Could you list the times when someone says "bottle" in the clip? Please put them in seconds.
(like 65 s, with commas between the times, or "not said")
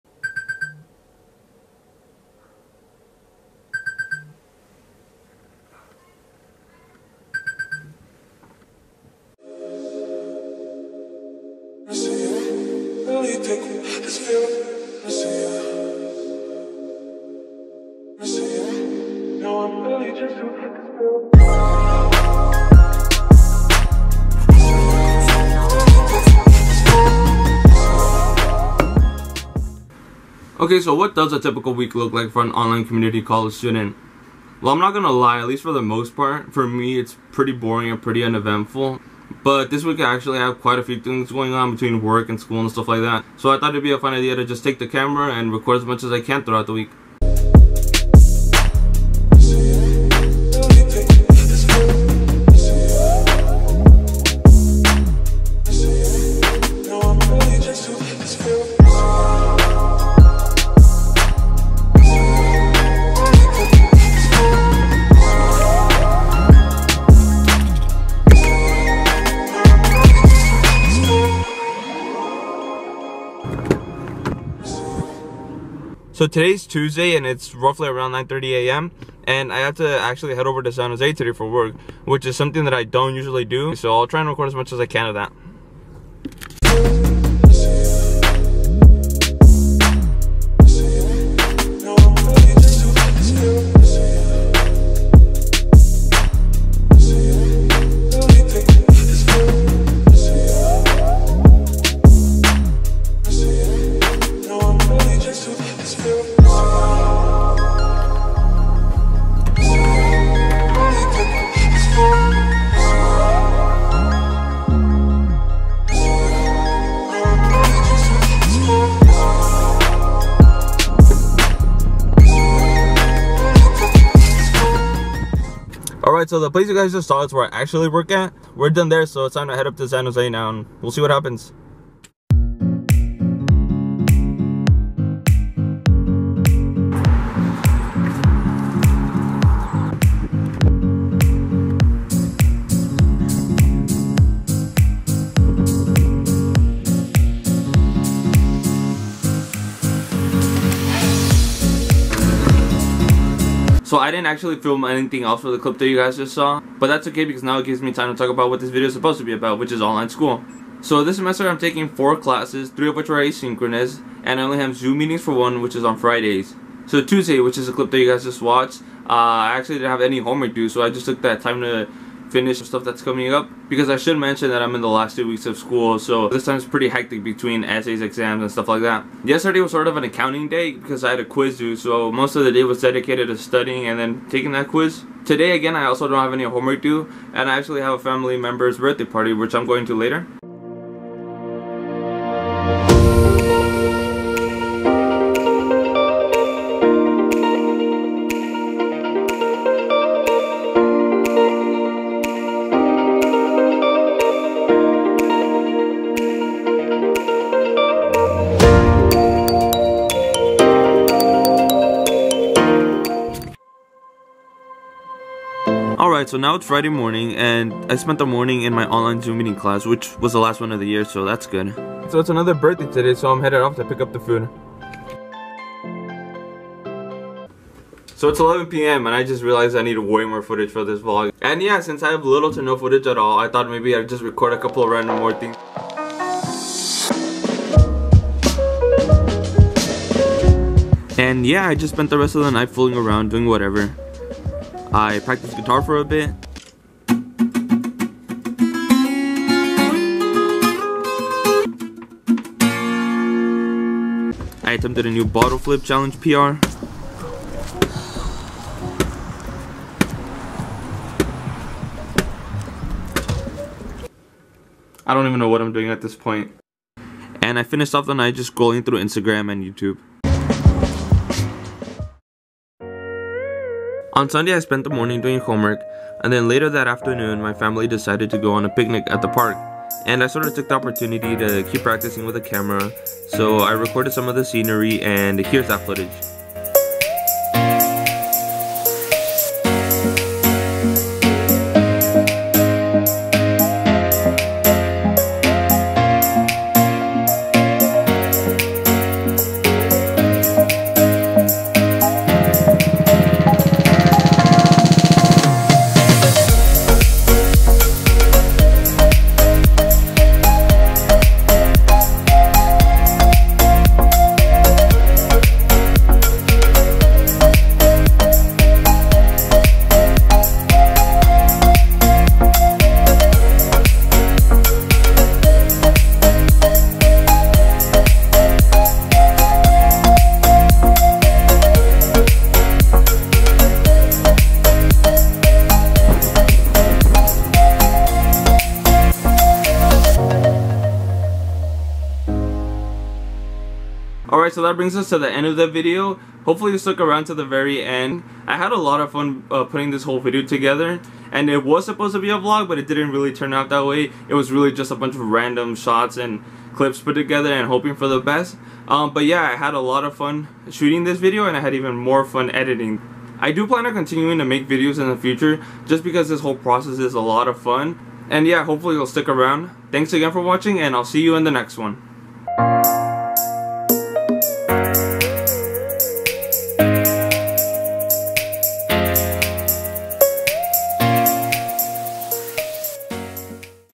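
255 s.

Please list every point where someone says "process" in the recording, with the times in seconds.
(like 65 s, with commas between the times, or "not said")
366 s.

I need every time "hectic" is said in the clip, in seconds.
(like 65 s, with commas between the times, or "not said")
176 s.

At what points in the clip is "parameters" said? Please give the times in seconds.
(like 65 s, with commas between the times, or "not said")
not said.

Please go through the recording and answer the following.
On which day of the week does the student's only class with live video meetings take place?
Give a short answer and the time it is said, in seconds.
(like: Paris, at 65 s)
Friday, at 165 s.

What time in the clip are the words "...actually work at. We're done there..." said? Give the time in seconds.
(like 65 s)
127 s.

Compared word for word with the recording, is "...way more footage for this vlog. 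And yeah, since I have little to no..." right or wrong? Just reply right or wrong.
right.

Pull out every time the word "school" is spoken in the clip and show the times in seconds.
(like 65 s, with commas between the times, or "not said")
42 s, 160 s, 175 s.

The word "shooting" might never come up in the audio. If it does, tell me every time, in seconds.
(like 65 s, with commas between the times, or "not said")
360 s.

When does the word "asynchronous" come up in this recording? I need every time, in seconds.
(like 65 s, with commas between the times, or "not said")
163 s.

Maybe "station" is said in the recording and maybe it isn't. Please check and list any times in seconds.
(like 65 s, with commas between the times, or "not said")
not said.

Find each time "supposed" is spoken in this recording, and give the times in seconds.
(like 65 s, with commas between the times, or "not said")
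158 s, 351 s.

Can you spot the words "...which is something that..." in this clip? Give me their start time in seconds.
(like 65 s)
82 s.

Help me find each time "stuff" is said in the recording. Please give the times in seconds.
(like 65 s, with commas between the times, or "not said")
42 s, 172 s, 178 s.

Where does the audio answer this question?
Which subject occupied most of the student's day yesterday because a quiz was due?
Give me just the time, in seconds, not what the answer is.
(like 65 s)
180 s.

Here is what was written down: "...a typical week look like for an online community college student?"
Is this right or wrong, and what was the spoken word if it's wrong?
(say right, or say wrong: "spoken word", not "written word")
right.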